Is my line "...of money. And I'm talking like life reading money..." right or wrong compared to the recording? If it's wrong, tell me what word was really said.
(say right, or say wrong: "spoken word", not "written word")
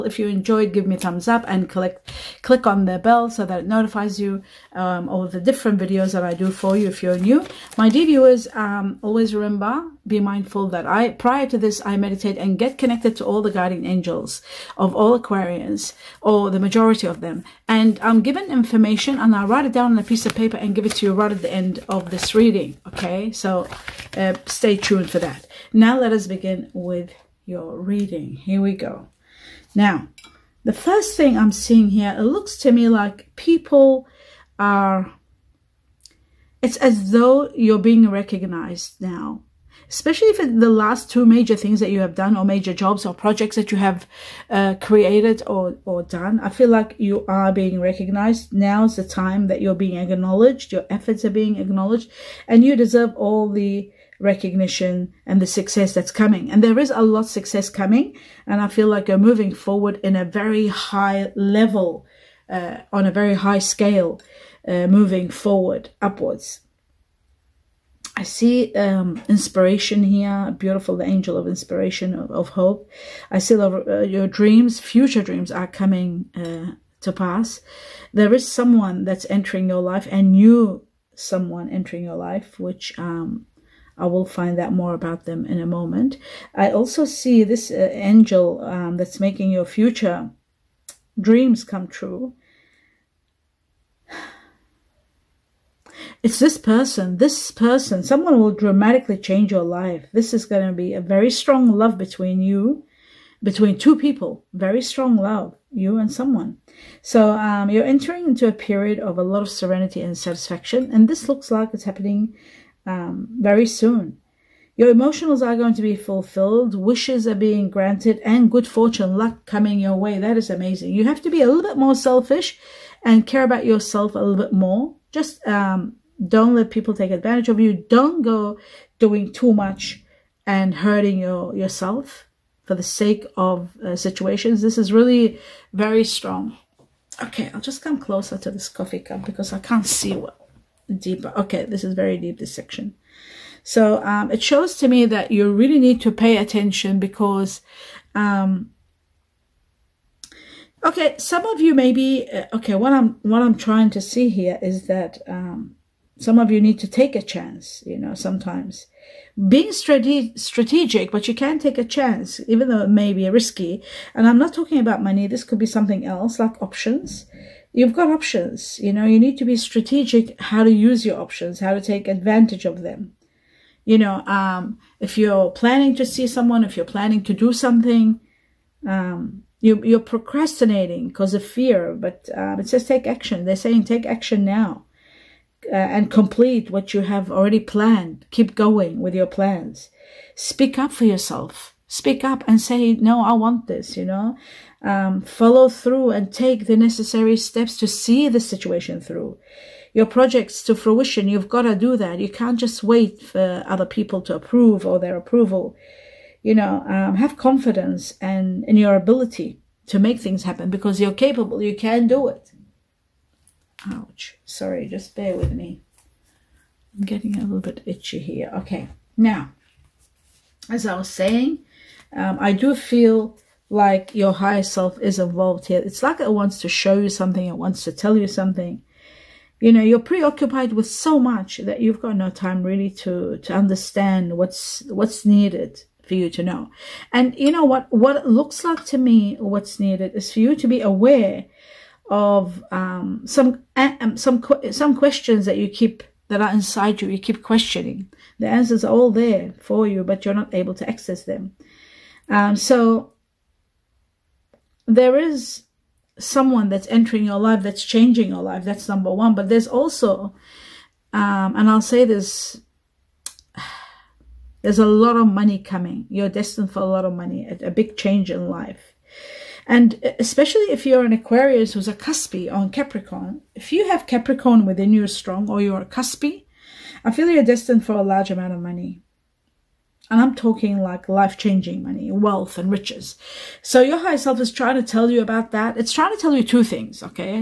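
wrong: "changing", not "reading".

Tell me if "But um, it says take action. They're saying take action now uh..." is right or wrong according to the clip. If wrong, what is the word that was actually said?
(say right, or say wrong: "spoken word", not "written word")
right.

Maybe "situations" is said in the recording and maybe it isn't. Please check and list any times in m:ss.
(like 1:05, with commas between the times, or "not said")
2:13, 3:18.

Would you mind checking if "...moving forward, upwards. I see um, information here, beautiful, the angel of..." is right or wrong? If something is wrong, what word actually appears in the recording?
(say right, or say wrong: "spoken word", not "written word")
wrong: "inspiration", not "information".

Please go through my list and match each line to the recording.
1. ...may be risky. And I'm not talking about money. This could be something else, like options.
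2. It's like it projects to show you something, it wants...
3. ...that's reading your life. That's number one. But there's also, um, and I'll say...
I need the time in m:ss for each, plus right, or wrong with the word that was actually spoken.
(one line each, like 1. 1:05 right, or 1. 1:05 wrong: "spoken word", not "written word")
1. 2:42 right
2. 3:45 wrong: "wants", not "projects"
3. 4:17 wrong: "changing", not "reading".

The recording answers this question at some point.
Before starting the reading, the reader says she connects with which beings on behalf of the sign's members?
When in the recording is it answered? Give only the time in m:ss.
0:13.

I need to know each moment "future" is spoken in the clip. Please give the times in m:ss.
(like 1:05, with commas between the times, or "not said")
1:14, 1:29.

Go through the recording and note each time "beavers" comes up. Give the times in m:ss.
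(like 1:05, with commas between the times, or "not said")
not said.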